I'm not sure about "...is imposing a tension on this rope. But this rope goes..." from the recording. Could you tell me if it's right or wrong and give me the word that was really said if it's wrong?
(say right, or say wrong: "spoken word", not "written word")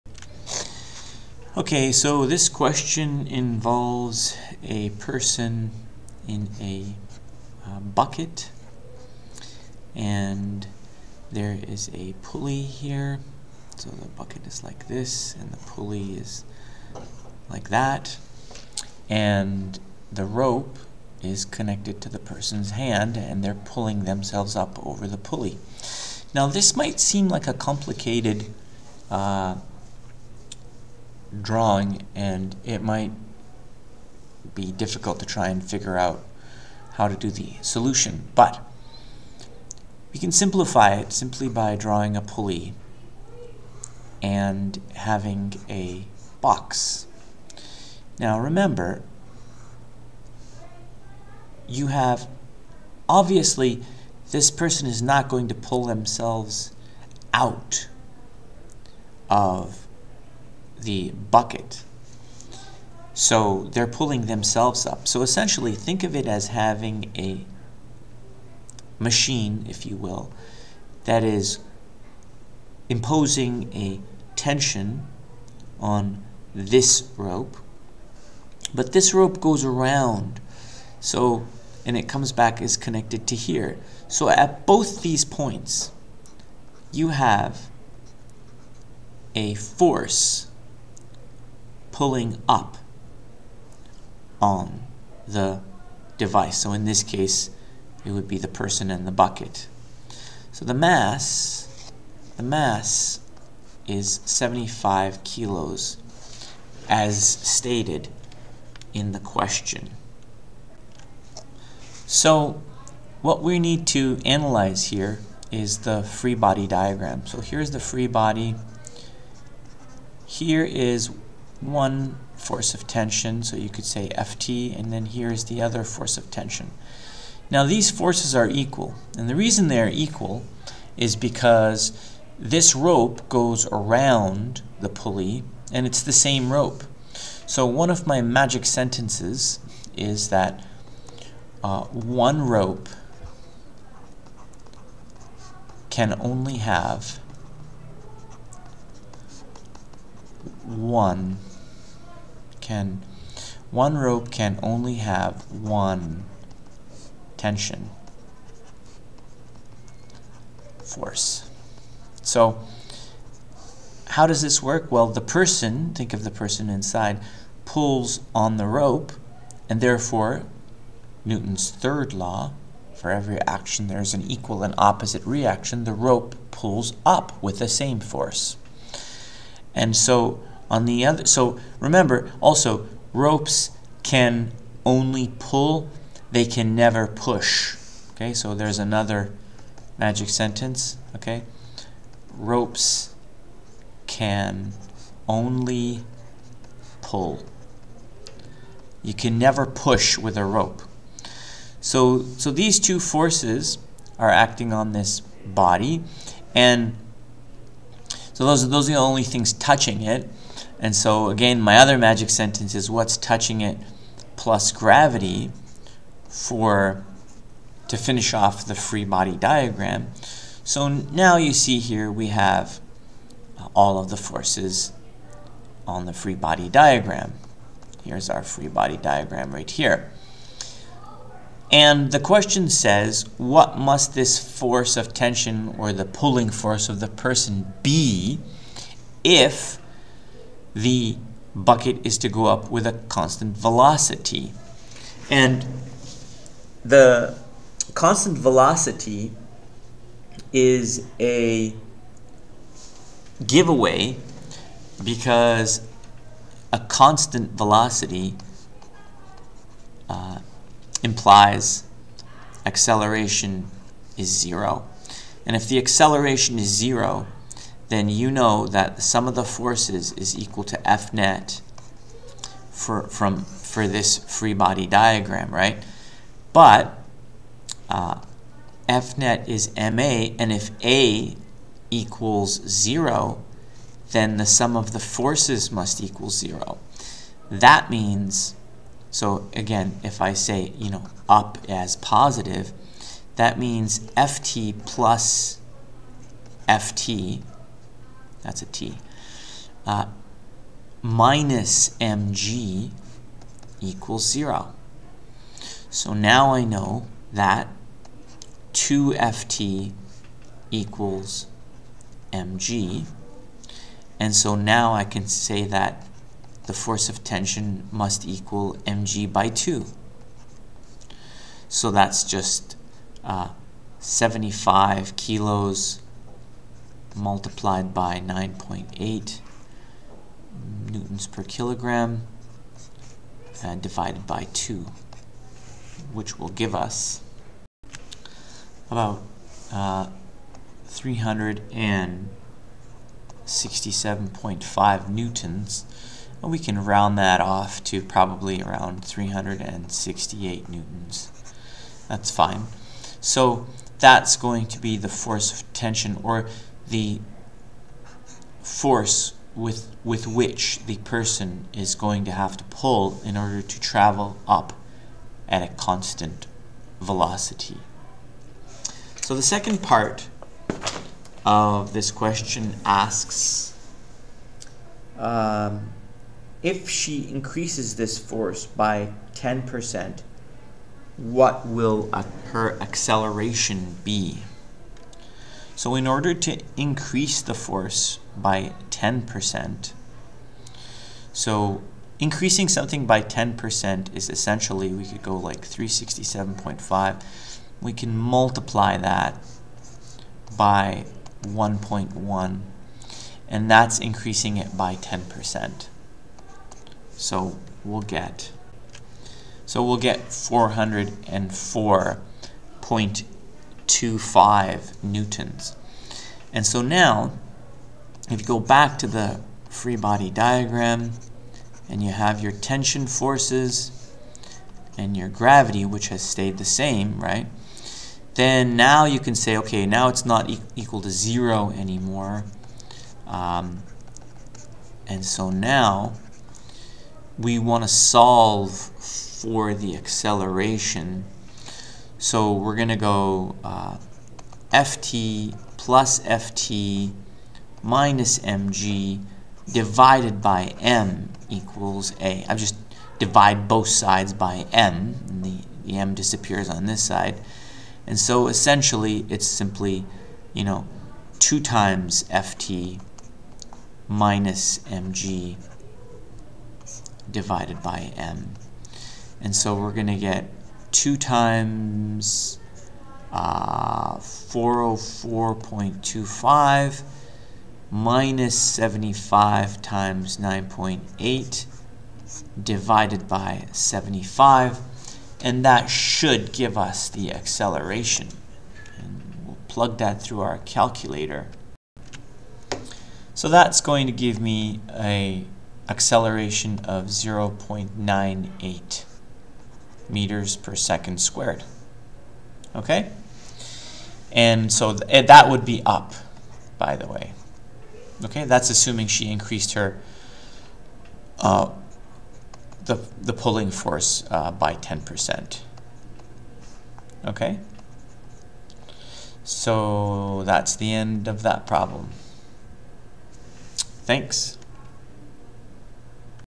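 right.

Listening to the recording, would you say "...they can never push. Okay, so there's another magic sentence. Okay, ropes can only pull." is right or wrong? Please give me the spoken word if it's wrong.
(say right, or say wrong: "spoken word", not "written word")
right.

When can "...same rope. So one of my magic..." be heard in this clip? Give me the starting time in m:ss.
2:16.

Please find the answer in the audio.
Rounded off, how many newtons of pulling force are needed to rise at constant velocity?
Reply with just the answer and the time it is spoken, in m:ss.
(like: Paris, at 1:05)
368 newtons, at 5:49.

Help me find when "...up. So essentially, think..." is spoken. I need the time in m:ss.
1:04.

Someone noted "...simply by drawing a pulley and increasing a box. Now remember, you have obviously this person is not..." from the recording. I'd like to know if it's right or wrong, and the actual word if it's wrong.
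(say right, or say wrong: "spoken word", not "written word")
wrong: "having", not "increasing".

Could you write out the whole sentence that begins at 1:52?
So what we need to analyze here is the free body diagram.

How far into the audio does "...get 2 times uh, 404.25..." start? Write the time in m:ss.
7:50.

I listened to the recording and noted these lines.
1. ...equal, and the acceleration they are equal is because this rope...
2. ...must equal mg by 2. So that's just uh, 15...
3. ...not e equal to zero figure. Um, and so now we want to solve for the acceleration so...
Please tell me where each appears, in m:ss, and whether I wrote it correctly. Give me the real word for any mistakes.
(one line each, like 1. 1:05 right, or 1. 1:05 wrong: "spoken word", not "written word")
1. 2:08 wrong: "reason", not "acceleration"
2. 5:17 wrong: "75", not "15"
3. 7:10 wrong: "anymore", not "figure".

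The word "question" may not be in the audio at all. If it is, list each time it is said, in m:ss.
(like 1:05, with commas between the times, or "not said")
0:02, 1:49, 3:52, 6:12.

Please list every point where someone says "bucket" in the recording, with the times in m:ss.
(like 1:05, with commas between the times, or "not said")
0:07, 0:14, 1:01, 1:39, 4:01.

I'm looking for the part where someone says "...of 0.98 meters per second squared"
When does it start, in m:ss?
8:16.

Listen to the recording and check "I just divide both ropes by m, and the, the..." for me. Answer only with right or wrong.
wrong.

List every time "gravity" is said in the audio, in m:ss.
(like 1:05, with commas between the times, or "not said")
3:34, 7:05.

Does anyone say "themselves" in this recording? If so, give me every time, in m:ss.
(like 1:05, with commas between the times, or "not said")
0:24, 0:55, 1:04.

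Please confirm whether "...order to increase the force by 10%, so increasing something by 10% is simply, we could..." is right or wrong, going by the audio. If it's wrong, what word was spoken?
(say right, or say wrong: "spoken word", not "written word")
wrong: "essentially", not "simply".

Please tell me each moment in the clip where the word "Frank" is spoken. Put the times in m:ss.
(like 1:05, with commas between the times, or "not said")
not said.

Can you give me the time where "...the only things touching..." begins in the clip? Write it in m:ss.
3:28.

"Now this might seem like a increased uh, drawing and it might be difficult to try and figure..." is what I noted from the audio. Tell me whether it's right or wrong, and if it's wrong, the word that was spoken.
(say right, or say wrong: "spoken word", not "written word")
wrong: "complicated", not "increased".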